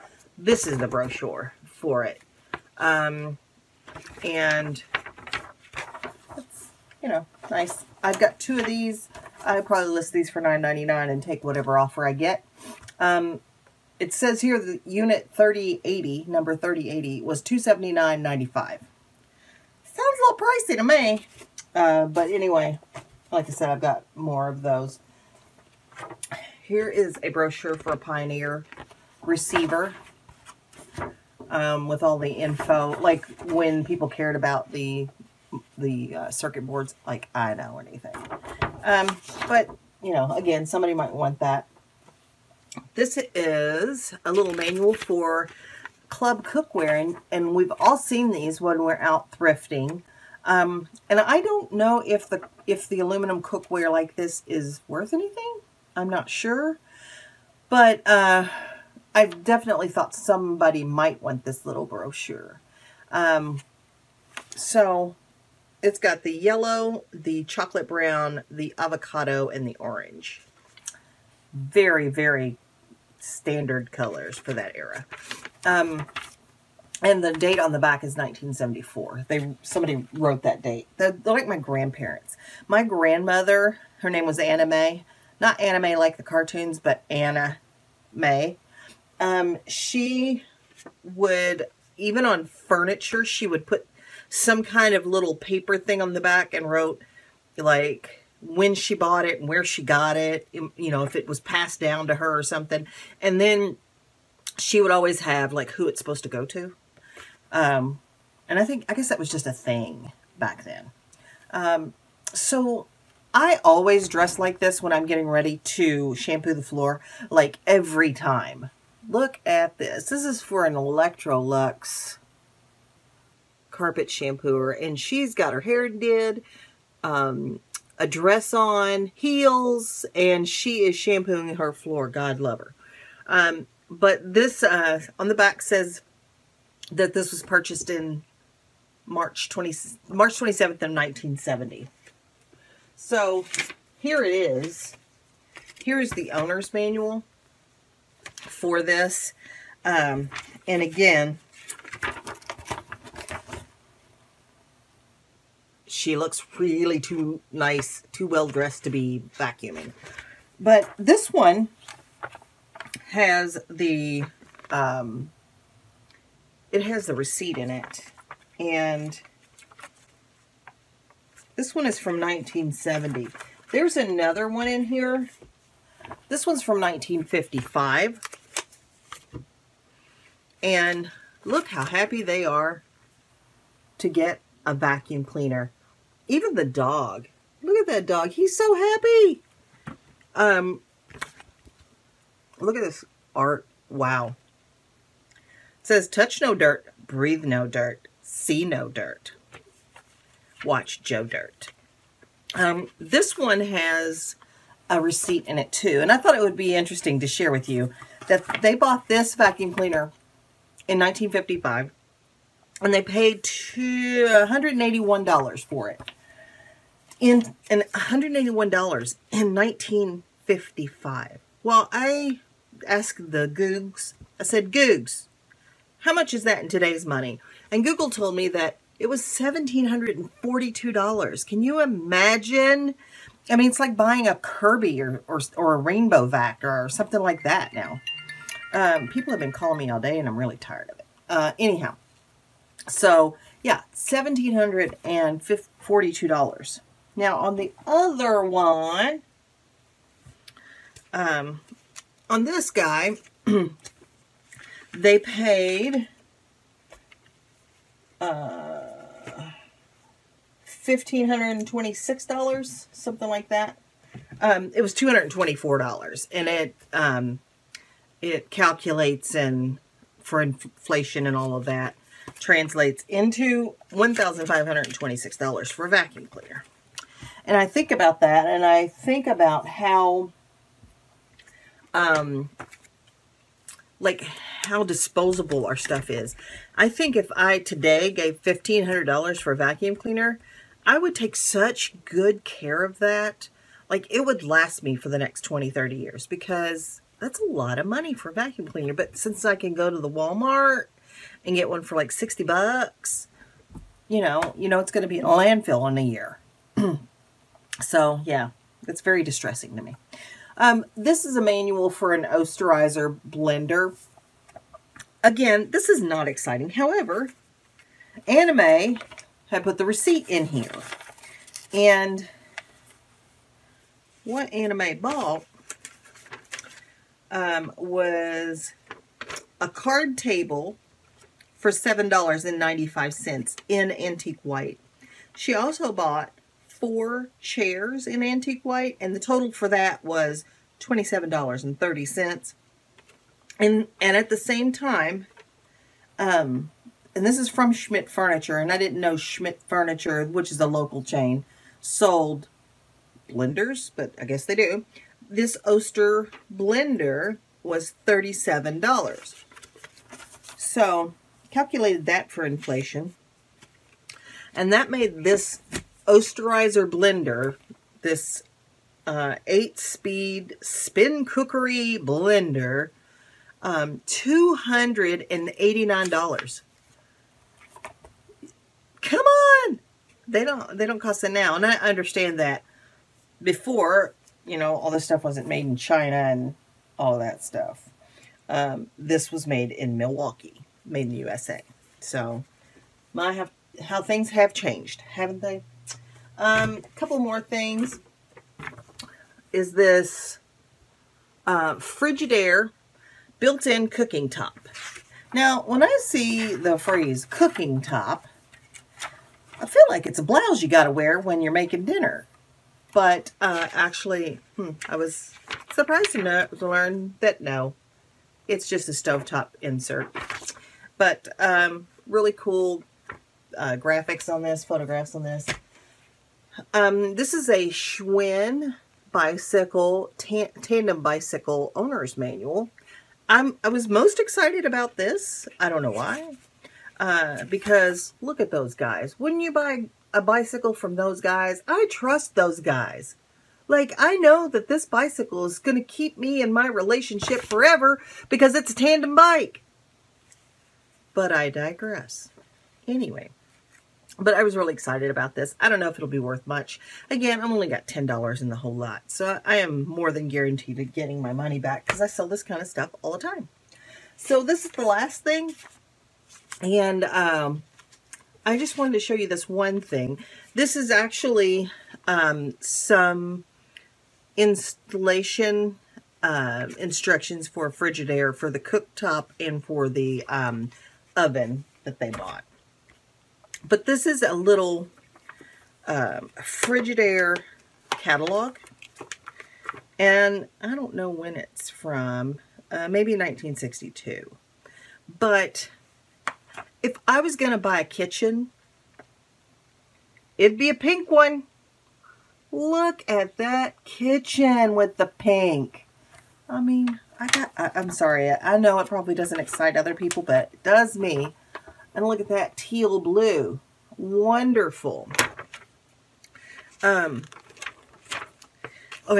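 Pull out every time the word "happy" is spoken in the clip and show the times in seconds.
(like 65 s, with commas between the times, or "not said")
181 s, 188 s.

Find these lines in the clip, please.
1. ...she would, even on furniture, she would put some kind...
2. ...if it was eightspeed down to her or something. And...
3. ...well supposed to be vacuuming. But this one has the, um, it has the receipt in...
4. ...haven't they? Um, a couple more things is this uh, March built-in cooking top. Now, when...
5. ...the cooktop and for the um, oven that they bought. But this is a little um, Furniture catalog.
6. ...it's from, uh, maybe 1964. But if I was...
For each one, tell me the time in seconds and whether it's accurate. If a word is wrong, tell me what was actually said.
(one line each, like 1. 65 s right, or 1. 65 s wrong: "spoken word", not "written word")
1. 89 s right
2. 101 s wrong: "passed", not "eightspeed"
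3. 158 s wrong: "dressed", not "supposed"
4. 395 s wrong: "Frigidaire", not "March"
5. 478 s wrong: "Frigidaire", not "Furniture"
6. 491 s wrong: "1962", not "1964".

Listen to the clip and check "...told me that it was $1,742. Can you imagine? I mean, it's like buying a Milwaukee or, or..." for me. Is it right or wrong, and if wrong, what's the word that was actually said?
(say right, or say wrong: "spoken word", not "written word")
wrong: "Kirby", not "Milwaukee".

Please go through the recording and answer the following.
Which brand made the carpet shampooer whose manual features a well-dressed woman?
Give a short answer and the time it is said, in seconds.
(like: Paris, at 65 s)
Electrolux, at 120 s.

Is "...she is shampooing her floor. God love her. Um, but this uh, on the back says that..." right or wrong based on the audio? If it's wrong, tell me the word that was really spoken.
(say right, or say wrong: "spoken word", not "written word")
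right.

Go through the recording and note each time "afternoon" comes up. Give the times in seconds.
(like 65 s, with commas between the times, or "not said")
not said.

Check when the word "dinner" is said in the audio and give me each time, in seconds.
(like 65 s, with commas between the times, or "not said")
411 s.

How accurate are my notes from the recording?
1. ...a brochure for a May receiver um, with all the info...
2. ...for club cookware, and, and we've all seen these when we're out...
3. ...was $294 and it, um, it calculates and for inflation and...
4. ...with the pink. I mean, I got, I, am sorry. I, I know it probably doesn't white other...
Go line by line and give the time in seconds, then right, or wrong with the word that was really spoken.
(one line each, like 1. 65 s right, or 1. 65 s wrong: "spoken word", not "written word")
1. 27 s wrong: "Pioneer", not "May"
2. 44 s right
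3. 264 s wrong: "224", not "294"
4. 504 s wrong: "excite", not "white".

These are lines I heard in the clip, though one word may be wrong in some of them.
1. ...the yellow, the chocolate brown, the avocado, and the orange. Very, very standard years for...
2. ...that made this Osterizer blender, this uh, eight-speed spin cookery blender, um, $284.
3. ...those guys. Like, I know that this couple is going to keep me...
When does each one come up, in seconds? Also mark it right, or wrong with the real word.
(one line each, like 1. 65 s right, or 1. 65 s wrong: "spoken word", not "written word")
1. 66 s wrong: "colors", not "years"
2. 364 s wrong: "289", not "284"
3. 442 s wrong: "bicycle", not "couple".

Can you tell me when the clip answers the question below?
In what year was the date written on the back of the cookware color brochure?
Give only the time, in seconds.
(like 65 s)
78 s.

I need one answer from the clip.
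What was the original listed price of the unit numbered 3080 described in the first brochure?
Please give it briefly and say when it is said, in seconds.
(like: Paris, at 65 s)
$279.95, at 17 s.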